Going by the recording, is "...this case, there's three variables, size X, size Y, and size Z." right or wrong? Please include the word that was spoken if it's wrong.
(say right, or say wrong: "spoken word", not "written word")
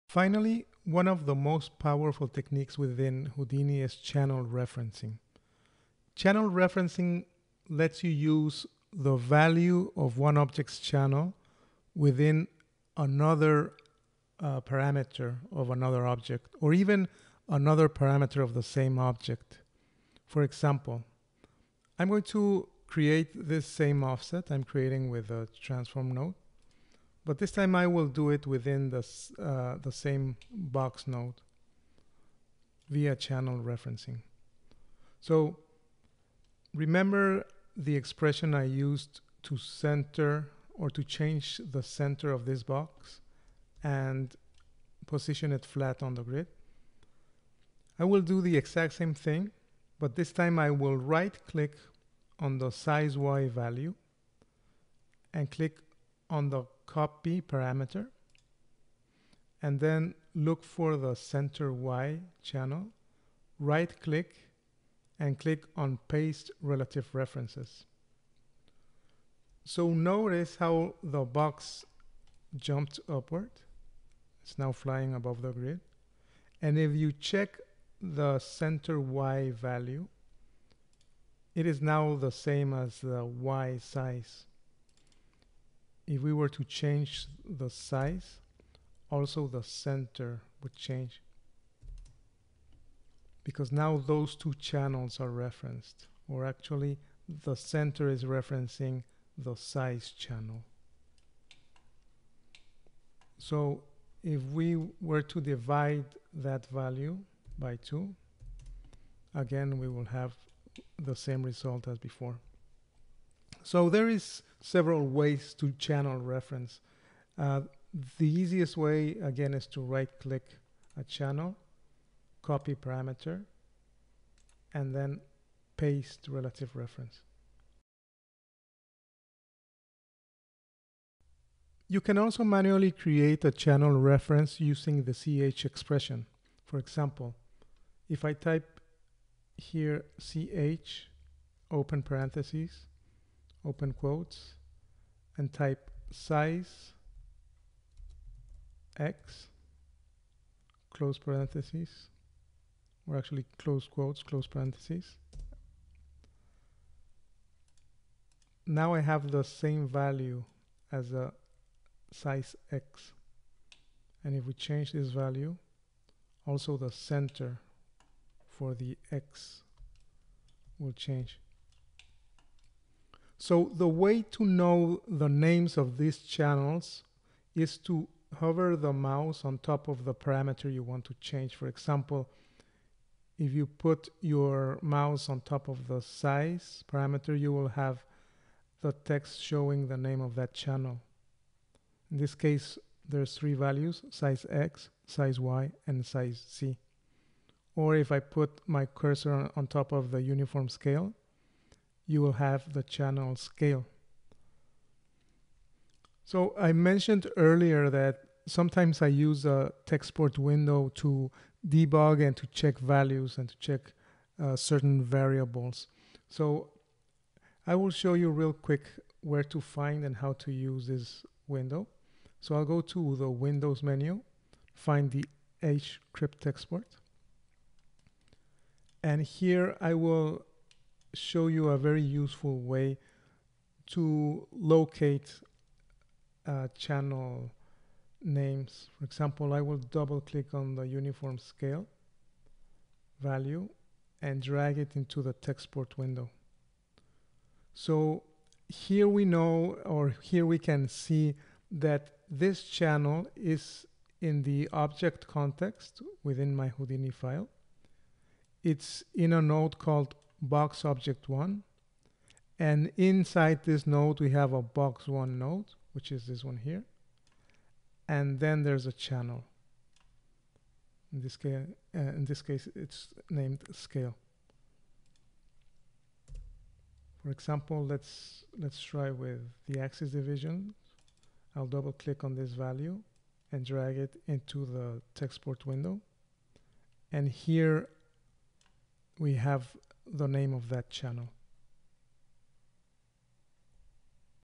wrong: "values", not "variables".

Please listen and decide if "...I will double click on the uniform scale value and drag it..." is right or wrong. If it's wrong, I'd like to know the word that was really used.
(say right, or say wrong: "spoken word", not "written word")
right.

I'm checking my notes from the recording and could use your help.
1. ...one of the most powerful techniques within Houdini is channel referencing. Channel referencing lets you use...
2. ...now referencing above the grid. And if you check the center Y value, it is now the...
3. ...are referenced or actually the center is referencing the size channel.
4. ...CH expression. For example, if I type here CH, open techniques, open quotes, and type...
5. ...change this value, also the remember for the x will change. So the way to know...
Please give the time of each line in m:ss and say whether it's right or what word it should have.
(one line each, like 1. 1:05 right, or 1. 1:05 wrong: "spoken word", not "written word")
1. 0:00 right
2. 1:14 wrong: "flying", not "referencing"
3. 1:35 right
4. 2:15 wrong: "parentheses", not "techniques"
5. 2:44 wrong: "center", not "remember".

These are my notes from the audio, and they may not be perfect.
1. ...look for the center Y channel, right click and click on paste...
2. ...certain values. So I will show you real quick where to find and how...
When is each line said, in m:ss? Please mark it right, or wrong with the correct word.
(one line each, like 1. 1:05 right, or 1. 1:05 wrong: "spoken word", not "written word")
1. 1:00 right
2. 3:34 wrong: "variables", not "values".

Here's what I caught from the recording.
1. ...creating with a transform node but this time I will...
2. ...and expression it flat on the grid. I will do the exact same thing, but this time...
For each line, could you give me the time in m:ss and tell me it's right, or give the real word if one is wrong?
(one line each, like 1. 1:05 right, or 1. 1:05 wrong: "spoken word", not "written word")
1. 0:24 right
2. 0:43 wrong: "position", not "expression".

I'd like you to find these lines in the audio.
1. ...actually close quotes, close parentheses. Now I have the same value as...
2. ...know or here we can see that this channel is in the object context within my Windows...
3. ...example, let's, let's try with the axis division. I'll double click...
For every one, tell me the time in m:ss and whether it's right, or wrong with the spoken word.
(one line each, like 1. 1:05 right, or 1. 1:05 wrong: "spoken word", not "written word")
1. 2:33 right
2. 4:09 wrong: "Houdini", not "Windows"
3. 4:37 right.